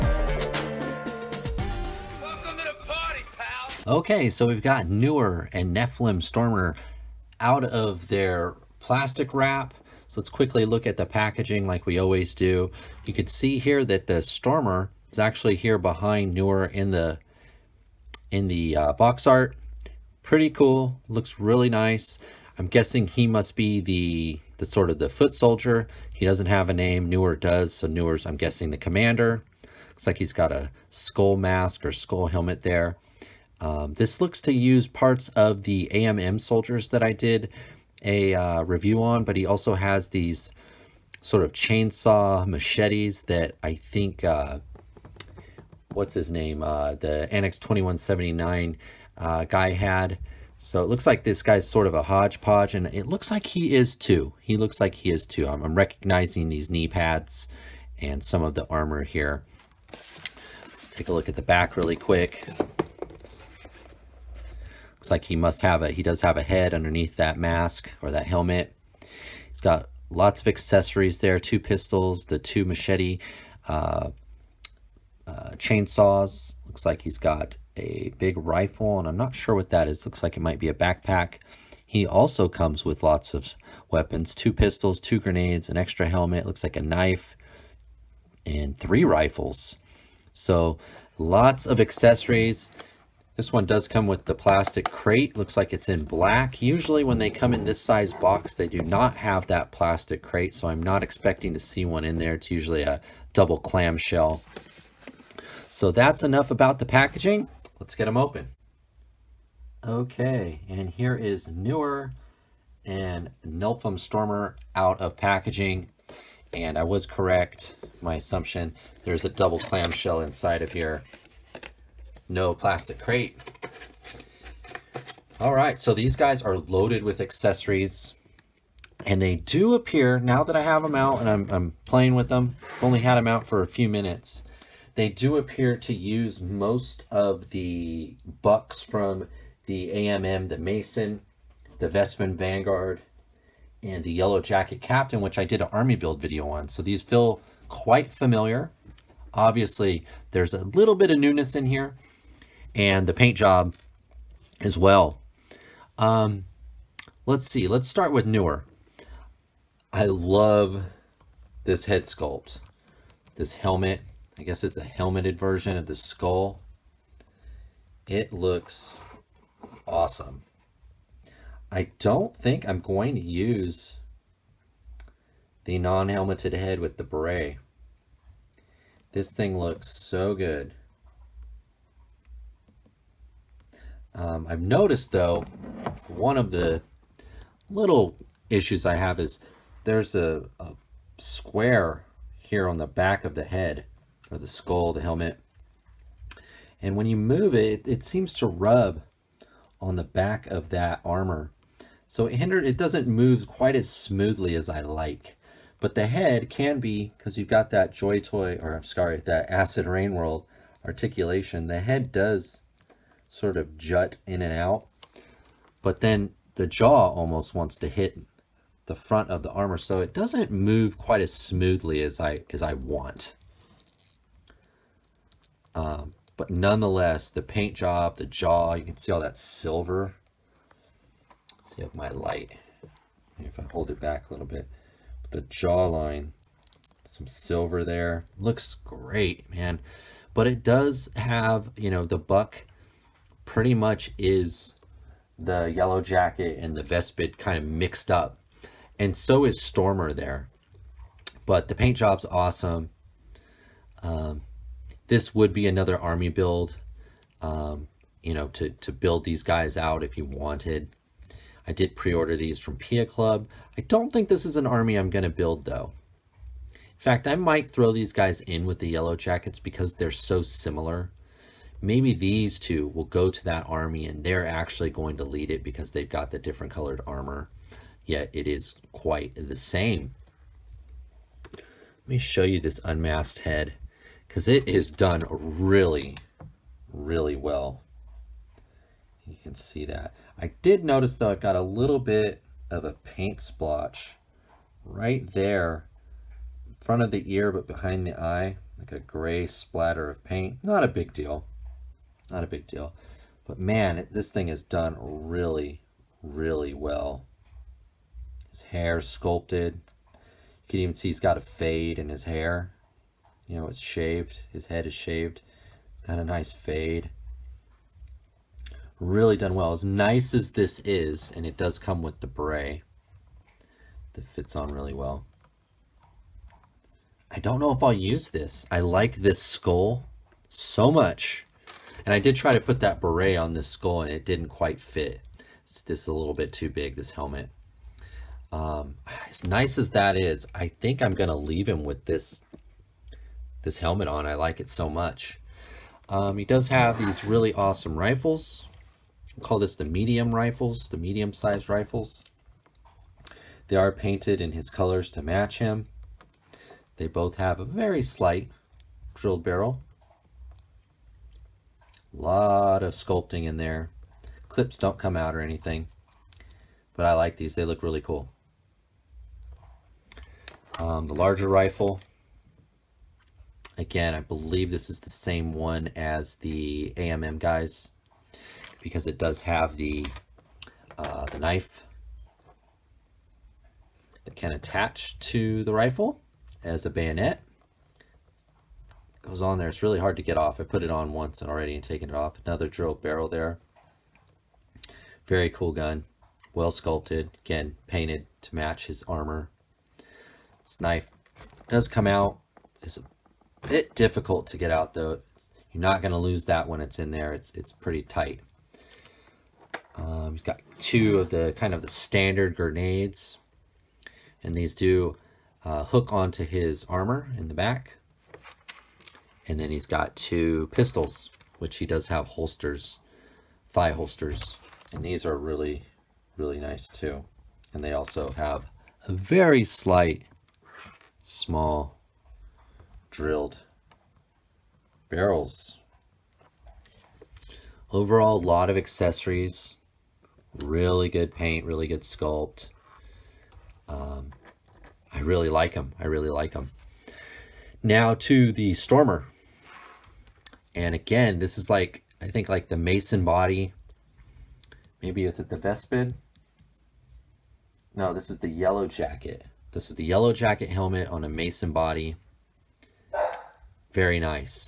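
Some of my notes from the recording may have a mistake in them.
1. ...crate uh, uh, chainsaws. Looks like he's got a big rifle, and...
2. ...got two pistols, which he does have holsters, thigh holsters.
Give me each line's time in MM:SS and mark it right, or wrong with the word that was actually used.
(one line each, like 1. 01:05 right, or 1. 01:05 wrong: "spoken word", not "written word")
1. 01:12 wrong: "machete", not "crate"
2. 06:59 right.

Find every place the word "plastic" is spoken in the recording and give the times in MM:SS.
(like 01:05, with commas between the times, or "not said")
00:08, 01:34, 01:39, 02:02.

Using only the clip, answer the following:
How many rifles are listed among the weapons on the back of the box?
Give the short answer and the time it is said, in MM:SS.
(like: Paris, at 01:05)
3, at 01:28.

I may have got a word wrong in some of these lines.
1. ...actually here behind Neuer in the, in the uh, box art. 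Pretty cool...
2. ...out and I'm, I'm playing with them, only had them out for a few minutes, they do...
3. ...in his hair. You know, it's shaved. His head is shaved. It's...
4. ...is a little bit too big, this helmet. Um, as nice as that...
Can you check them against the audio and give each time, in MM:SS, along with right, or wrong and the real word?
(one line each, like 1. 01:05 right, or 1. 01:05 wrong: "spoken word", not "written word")
1. 00:15 right
2. 02:10 right
3. 05:11 right
4. 05:36 right.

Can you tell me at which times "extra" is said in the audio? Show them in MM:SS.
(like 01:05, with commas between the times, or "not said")
01:25.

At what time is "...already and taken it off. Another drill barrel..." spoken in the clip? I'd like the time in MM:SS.
06:31.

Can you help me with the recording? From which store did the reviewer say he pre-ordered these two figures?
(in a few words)
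Pia Club.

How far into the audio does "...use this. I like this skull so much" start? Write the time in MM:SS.
05:27.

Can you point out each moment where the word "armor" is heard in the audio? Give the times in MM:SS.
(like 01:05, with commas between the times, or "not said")
00:58, 03:21, 03:39, 04:37, 06:39, 06:56.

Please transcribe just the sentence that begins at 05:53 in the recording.
They are painted in his colors to match him.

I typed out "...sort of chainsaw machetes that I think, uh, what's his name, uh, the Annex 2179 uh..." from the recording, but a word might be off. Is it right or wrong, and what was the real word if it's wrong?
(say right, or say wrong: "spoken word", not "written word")
right.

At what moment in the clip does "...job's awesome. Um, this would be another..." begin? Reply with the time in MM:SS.
04:11.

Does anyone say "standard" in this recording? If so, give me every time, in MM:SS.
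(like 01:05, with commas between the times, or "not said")
06:51.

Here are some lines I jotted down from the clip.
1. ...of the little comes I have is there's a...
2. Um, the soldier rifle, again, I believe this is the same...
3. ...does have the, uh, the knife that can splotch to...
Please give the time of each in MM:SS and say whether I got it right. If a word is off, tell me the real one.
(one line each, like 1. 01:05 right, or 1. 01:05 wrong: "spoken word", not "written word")
1. 03:06 wrong: "issues", not "comes"
2. 06:10 wrong: "larger", not "soldier"
3. 06:19 wrong: "attach", not "splotch".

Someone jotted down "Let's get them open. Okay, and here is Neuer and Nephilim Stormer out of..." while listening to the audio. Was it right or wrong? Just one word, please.
right.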